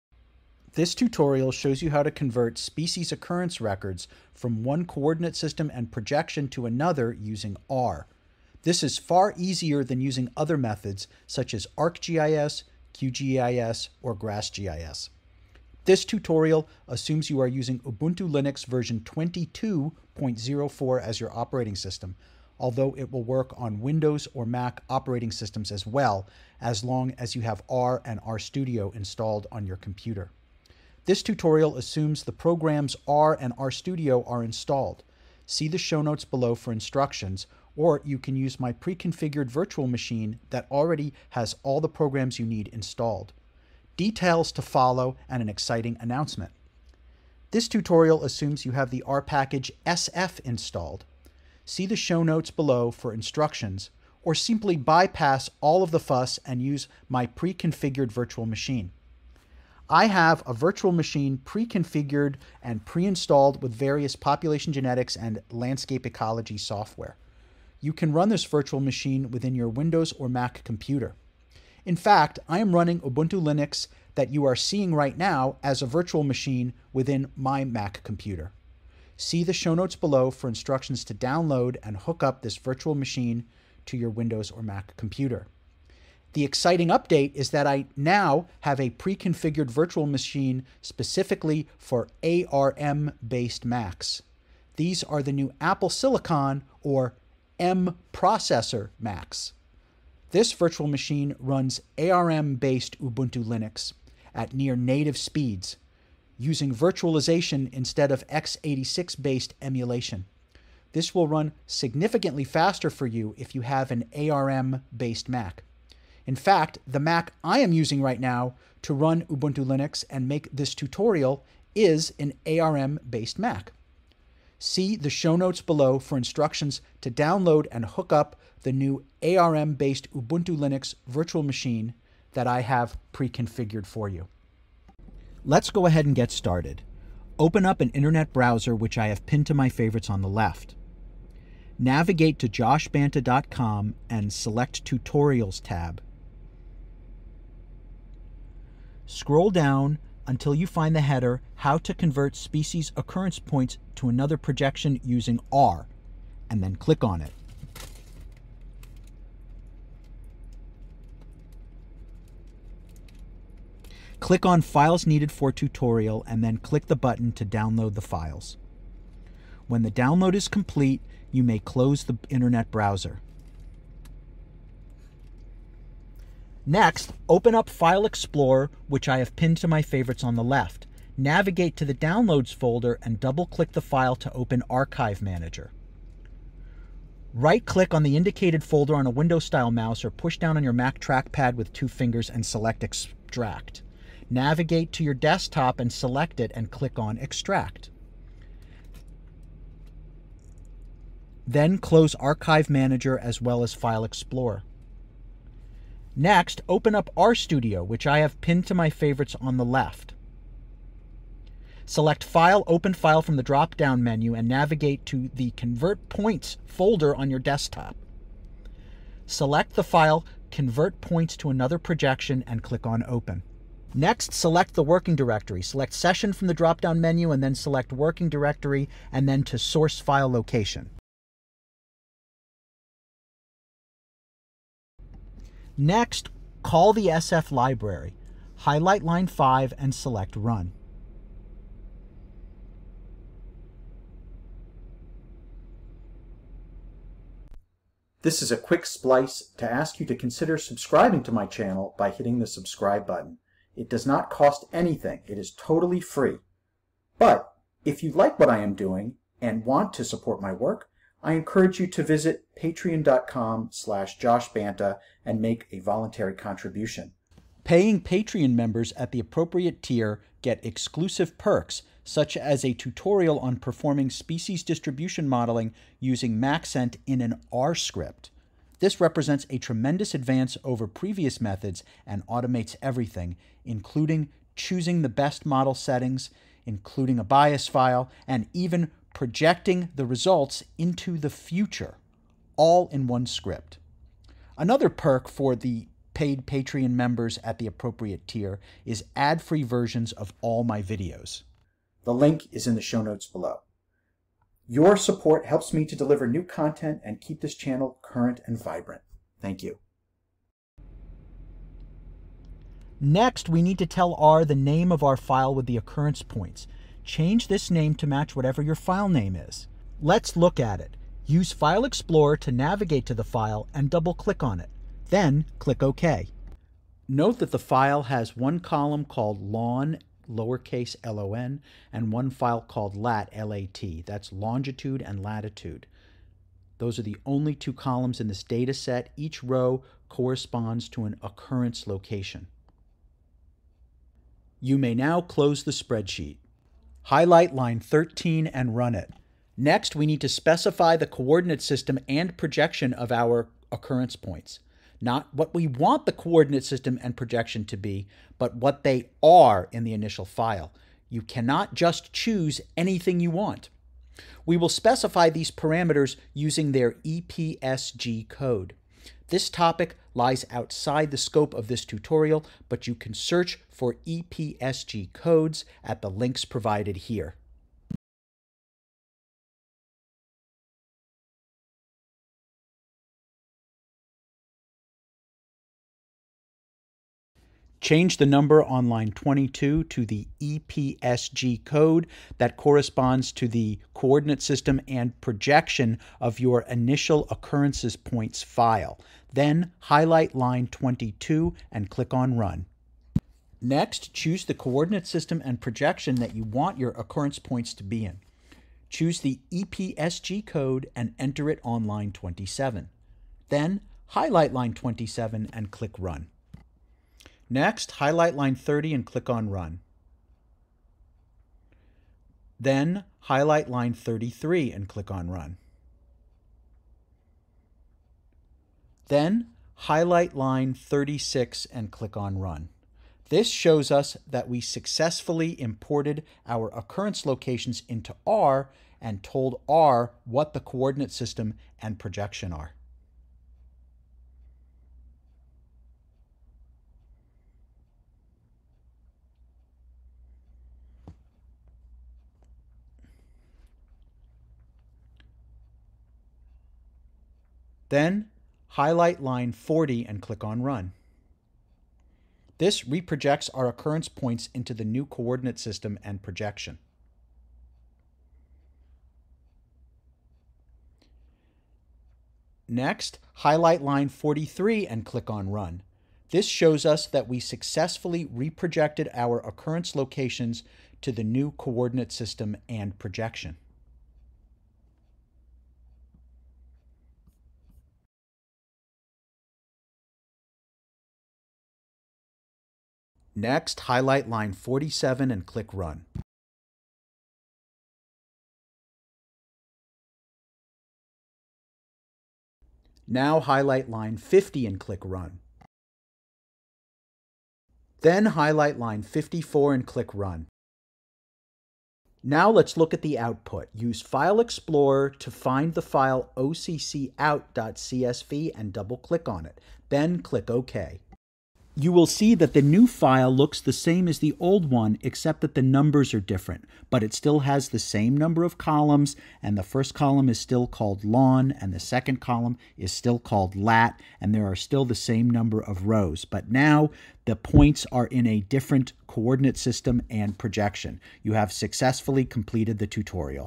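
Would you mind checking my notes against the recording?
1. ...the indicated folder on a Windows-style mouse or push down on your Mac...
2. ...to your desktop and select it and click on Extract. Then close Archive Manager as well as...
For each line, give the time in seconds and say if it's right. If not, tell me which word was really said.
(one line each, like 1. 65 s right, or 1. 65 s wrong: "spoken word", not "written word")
1. 188 s right
2. 194 s right.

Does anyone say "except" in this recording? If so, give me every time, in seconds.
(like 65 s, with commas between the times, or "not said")
525 s.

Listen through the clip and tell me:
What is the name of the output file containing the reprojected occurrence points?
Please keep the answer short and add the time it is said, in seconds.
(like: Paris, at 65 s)
occout.csv, at 516 s.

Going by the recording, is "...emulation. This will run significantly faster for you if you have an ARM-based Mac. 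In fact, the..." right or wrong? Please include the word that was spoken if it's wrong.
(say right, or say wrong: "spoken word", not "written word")
right.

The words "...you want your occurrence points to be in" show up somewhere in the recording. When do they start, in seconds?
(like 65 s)
406 s.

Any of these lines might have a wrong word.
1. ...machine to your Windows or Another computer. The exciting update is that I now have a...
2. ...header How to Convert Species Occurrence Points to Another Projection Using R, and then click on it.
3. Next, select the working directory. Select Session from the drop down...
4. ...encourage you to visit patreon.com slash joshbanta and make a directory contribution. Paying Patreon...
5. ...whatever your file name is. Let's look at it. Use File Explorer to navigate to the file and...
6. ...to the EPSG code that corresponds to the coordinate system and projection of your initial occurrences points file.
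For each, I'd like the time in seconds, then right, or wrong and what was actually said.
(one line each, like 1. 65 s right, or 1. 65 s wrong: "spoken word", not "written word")
1. 82 s wrong: "Mac", not "Another"
2. 151 s right
3. 223 s right
4. 261 s wrong: "voluntary", not "directory"
5. 318 s right
6. 389 s right.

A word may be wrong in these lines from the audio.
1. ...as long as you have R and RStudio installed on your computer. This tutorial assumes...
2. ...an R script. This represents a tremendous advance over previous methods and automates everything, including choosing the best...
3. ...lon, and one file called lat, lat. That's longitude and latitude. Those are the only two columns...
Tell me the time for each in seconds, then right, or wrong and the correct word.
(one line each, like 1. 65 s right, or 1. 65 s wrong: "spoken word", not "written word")
1. 26 s right
2. 277 s right
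3. 331 s right.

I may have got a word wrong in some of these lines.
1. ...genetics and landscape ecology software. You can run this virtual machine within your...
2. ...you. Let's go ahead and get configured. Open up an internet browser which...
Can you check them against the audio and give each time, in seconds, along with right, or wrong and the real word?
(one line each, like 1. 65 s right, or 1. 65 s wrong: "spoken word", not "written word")
1. 64 s right
2. 134 s wrong: "started", not "configured".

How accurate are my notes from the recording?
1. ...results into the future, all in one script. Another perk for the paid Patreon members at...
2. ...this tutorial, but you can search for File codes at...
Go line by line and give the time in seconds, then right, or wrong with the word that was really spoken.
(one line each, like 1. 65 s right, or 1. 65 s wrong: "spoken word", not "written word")
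1. 290 s right
2. 371 s wrong: "EPSG", not "File".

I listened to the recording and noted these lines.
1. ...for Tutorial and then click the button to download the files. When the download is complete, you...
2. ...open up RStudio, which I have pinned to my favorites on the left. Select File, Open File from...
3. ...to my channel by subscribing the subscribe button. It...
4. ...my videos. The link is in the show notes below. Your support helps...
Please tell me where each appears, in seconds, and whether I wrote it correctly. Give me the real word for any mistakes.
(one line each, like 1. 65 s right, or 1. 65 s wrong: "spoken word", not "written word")
1. 165 s right
2. 206 s right
3. 251 s wrong: "hitting", not "subscribing"
4. 300 s right.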